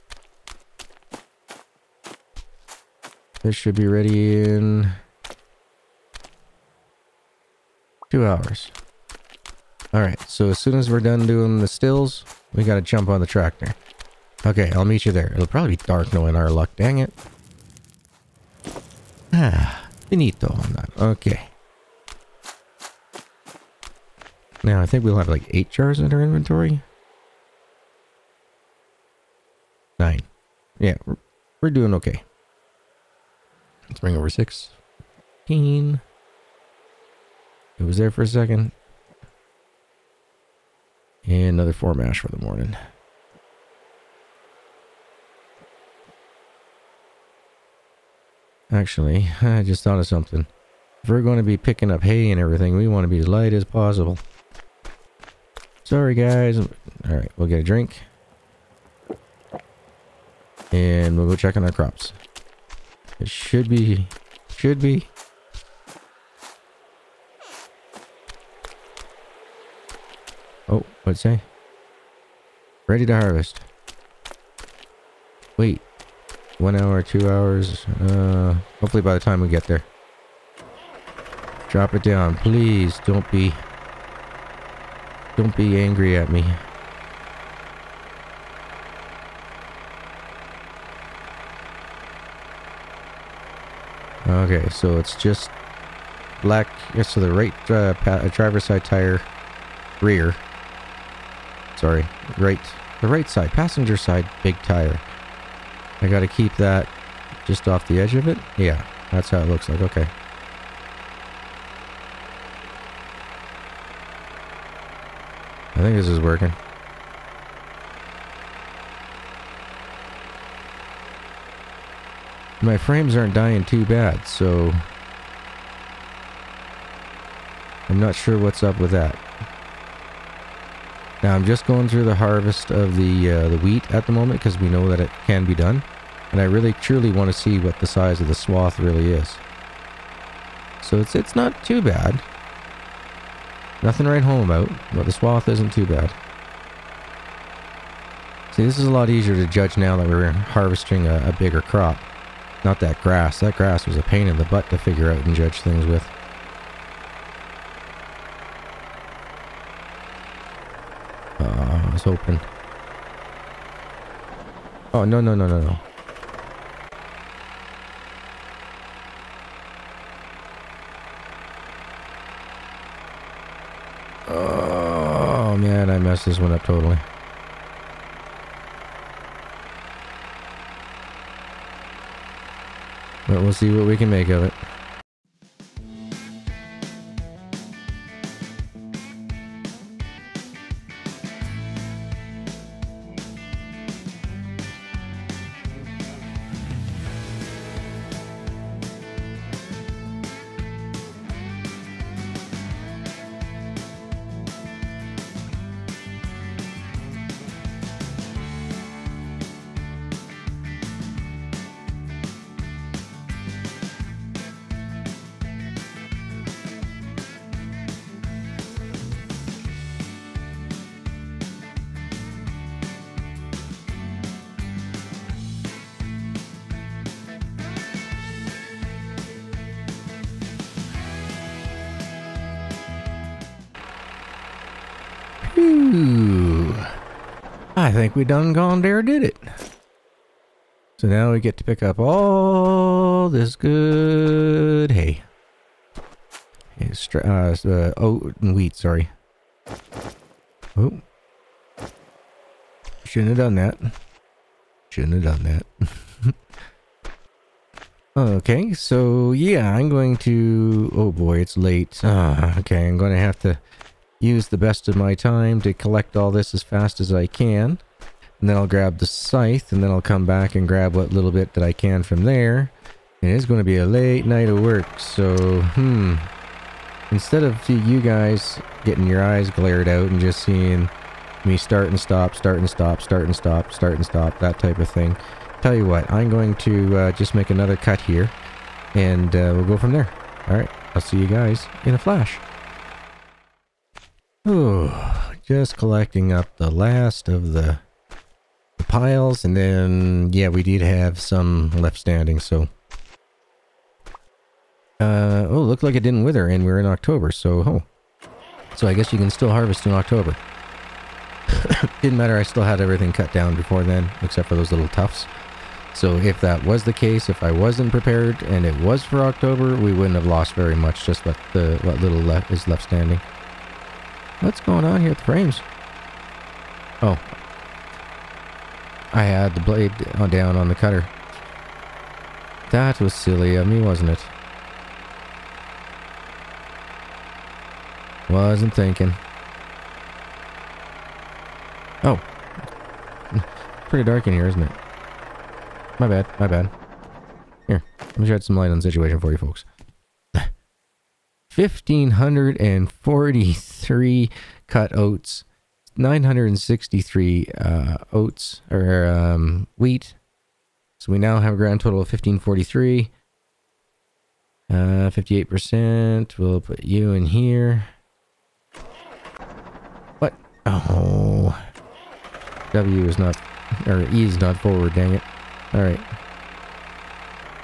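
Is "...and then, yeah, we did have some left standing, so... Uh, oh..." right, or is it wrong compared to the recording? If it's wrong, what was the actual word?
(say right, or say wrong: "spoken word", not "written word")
right.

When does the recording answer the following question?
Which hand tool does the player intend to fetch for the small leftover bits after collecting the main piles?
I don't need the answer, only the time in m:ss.
4:28.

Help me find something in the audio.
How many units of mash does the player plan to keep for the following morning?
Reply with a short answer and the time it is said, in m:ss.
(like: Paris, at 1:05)
4, at 0:41.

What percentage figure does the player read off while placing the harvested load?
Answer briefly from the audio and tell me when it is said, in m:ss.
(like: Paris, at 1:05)
58%, at 6:05.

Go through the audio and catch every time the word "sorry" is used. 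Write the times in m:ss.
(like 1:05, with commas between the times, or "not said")
0:55, 1:41, 4:08.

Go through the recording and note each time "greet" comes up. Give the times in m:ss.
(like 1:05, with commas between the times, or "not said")
not said.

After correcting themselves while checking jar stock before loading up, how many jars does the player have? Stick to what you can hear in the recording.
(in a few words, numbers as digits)
9.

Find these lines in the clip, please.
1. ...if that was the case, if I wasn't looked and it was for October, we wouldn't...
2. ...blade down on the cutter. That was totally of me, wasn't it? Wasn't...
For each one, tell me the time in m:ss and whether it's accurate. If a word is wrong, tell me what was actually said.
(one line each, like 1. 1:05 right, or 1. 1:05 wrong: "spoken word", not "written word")
1. 5:16 wrong: "prepared", not "looked"
2. 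5:29 wrong: "silly", not "totally".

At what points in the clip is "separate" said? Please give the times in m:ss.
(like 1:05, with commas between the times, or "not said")
not said.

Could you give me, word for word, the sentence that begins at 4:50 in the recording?
Alright, I'll see you guys in a flash.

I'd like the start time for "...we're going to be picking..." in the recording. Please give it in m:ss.
0:51.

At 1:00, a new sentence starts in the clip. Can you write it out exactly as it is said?
And we'll go check on our crops.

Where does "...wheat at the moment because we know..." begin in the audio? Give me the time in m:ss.
2:13.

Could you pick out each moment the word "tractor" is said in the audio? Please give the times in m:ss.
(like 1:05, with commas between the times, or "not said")
0:13.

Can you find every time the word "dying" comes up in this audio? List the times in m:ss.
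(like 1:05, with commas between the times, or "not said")
2:03.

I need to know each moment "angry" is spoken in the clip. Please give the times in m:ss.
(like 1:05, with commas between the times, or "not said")
1:25.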